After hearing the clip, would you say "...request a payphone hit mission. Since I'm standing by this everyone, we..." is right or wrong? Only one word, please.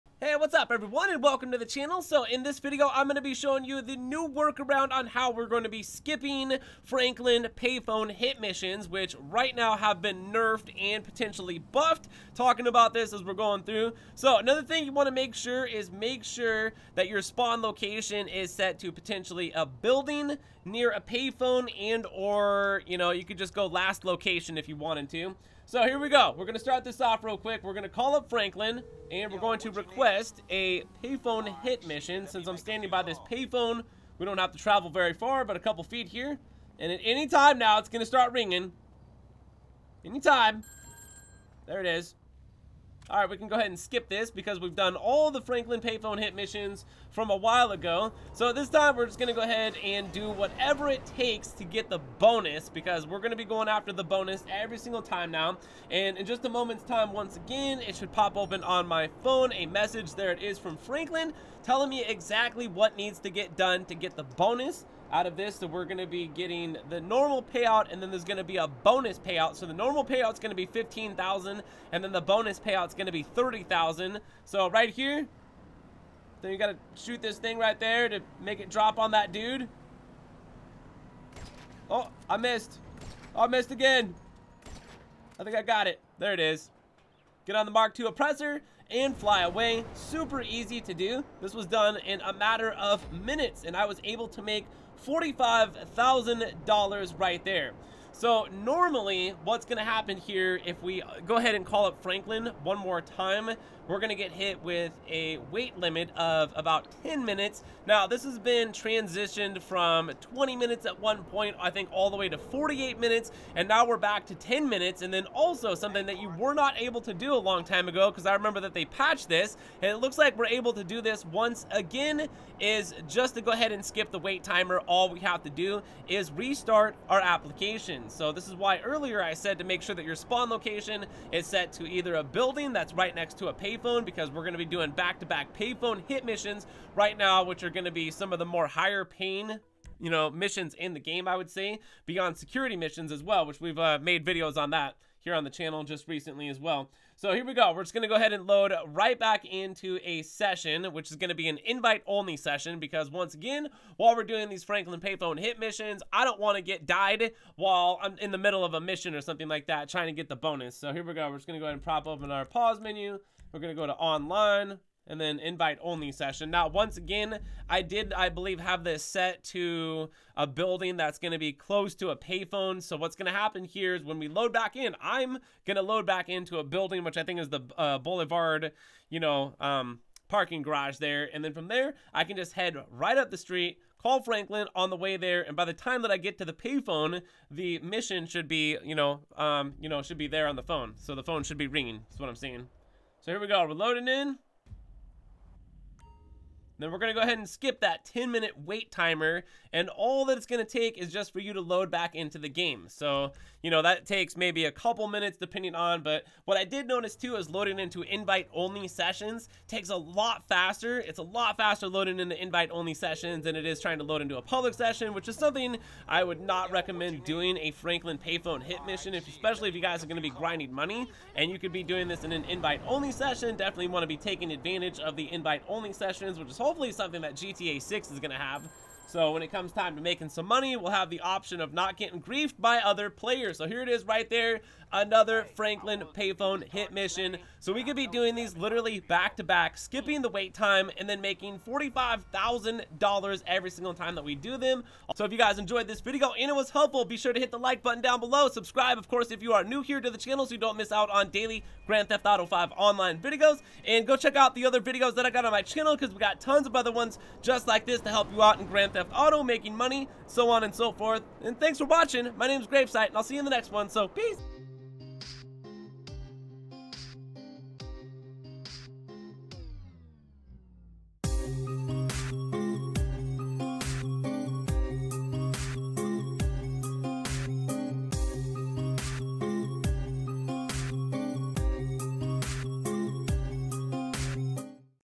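wrong.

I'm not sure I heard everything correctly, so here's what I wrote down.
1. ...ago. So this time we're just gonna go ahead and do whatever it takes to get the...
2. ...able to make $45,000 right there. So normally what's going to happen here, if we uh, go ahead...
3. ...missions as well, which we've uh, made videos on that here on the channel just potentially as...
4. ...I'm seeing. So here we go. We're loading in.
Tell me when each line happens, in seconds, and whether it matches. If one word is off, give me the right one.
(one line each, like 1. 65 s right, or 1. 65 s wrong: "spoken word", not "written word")
1. 47 s right
2. 94 s right
3. 142 s wrong: "recently", not "potentially"
4. 192 s right.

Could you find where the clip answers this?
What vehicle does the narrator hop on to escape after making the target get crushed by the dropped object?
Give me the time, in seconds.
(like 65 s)
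87 s.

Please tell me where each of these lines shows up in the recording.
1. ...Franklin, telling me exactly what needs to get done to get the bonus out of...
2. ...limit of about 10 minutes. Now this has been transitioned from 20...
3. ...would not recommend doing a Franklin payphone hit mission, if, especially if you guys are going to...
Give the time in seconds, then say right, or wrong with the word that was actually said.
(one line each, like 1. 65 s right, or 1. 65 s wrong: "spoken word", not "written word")
1. 60 s right
2. 105 s right
3. 216 s right.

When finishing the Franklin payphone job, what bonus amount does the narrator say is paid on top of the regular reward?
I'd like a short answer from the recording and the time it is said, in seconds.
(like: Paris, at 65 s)
30,000, at 73 s.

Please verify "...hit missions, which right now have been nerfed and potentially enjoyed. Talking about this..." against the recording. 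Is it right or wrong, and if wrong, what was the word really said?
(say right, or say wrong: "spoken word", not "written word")
wrong: "buffed", not "enjoyed".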